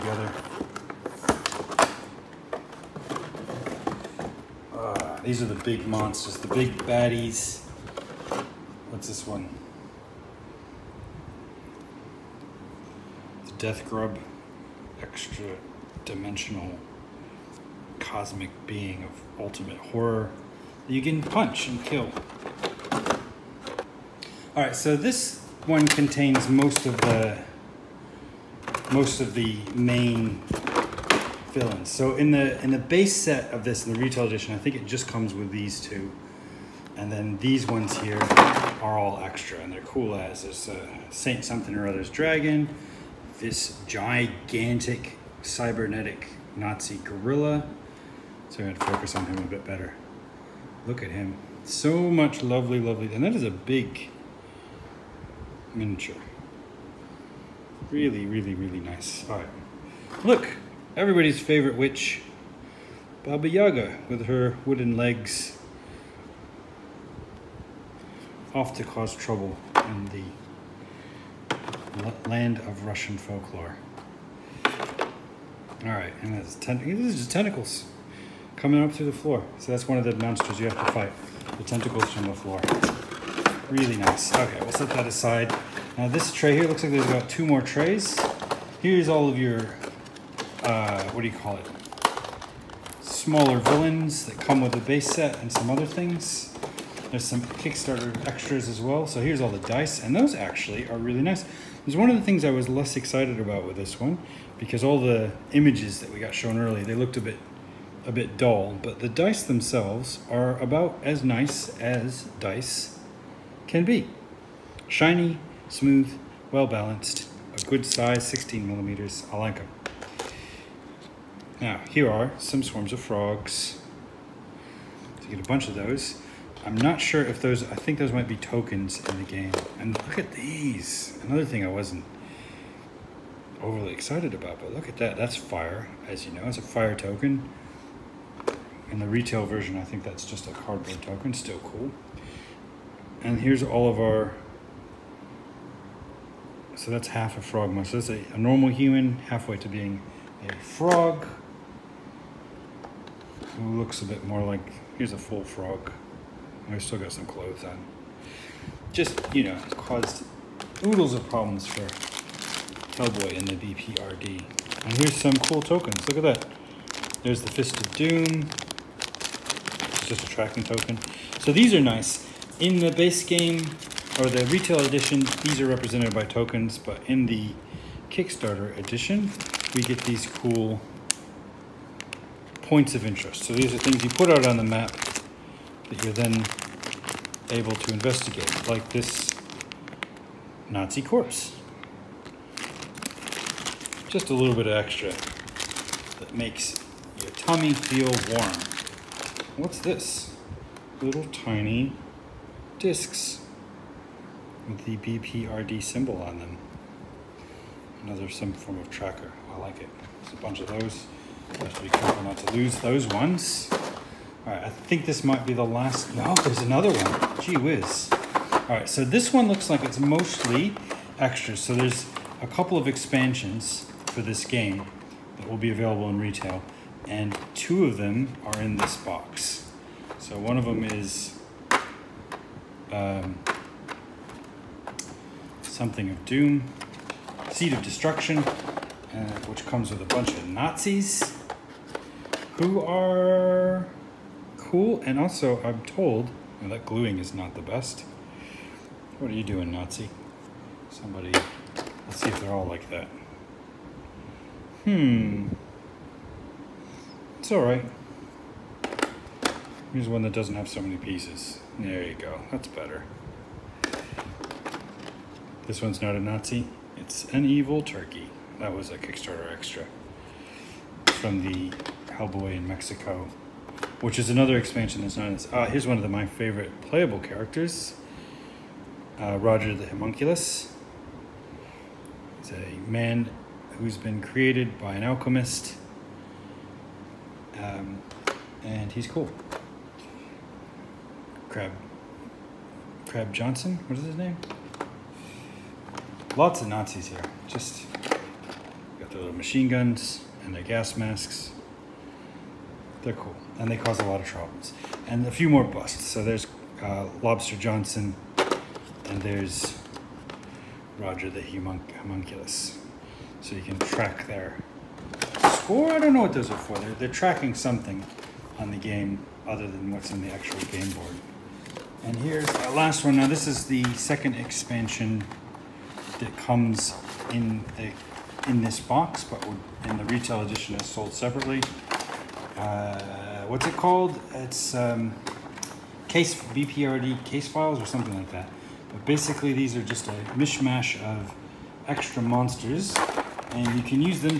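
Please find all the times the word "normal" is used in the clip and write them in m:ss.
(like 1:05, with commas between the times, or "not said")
2:28.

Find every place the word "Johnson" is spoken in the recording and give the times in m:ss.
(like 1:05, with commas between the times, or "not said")
4:53, 5:07.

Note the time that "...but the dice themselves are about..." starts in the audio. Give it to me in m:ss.
1:48.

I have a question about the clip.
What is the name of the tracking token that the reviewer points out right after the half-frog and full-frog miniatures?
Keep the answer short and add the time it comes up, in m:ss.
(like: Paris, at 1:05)
Fist of Doom, at 2:47.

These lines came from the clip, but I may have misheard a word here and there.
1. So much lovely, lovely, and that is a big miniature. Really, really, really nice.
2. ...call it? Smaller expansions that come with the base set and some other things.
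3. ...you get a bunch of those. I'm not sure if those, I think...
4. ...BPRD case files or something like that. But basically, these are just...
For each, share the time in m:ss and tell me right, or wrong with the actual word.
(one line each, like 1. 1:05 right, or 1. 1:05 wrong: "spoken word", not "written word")
1. 0:51 right
2. 1:31 wrong: "villains", not "expansions"
3. 2:05 right
4. 5:36 right.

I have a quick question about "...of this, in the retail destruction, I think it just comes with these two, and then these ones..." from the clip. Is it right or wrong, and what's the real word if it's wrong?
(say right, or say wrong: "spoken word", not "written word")
wrong: "edition", not "destruction".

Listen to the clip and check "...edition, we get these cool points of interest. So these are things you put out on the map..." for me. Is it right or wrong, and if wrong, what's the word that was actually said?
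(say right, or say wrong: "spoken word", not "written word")
right.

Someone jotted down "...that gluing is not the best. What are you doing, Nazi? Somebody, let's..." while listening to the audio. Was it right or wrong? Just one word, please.
right.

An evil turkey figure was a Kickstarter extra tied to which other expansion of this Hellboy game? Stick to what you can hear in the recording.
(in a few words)
Hellboy in Mexico.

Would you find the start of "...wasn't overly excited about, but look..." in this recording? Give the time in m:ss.
2:11.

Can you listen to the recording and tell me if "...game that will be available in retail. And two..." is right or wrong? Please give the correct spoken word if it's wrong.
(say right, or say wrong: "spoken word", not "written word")
right.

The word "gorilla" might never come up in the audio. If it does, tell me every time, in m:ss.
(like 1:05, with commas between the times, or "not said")
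0:46.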